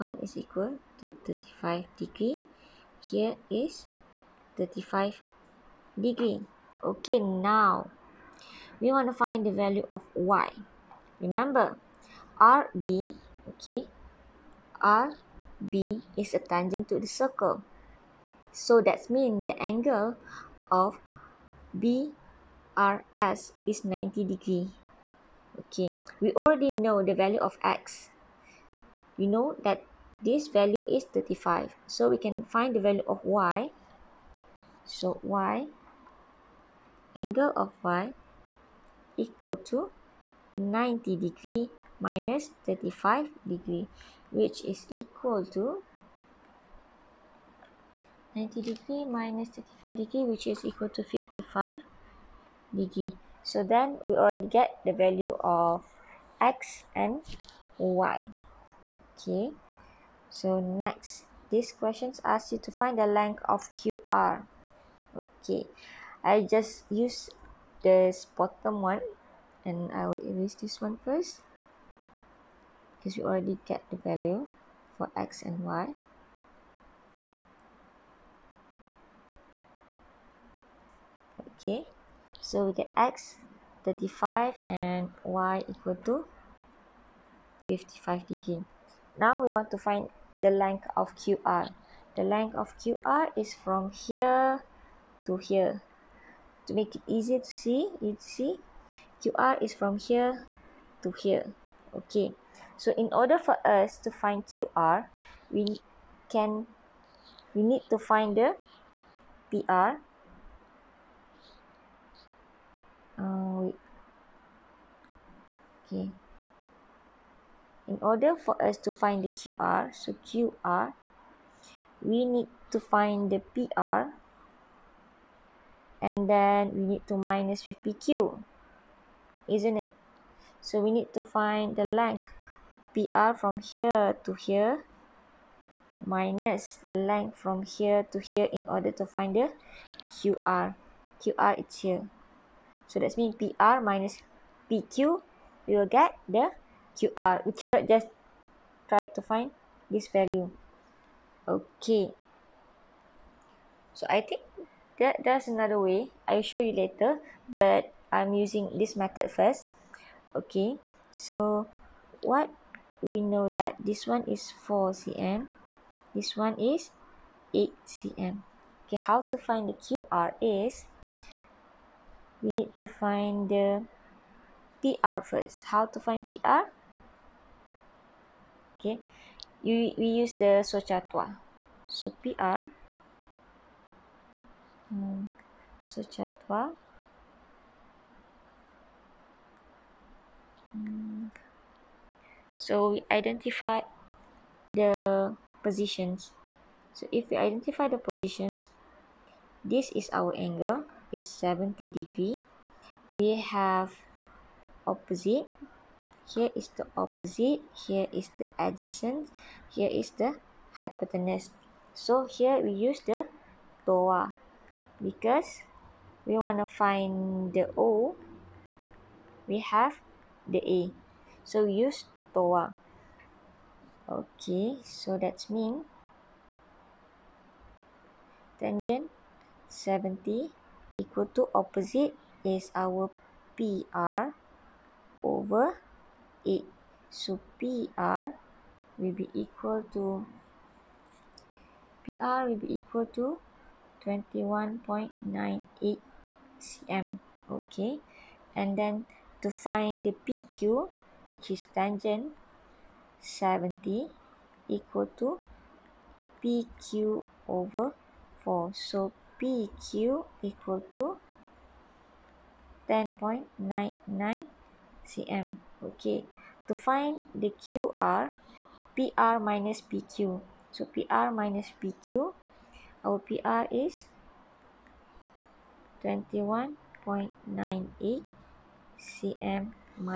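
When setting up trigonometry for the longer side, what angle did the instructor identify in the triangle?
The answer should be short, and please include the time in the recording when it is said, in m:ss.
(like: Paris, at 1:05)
70 degrees, at 3:21.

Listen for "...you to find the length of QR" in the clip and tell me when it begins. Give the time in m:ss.
1:02.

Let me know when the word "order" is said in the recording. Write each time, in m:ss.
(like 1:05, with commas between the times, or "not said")
1:43, 1:58, 2:18.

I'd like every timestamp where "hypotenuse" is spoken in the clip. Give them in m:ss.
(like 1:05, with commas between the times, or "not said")
3:30.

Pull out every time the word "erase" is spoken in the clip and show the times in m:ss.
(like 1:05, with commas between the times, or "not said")
1:10.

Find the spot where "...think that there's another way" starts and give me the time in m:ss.
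2:34.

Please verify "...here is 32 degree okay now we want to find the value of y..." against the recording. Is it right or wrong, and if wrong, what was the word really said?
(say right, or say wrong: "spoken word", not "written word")
wrong: "35", not "32".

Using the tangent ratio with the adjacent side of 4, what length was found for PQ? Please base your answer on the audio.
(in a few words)
10.99 cm.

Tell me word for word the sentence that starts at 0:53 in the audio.
So then we already get the value of x and y.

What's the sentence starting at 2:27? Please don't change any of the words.
We cannot just try to find this value.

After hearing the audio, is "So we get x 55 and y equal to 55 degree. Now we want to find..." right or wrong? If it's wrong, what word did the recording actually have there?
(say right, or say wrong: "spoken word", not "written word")
wrong: "35", not "55".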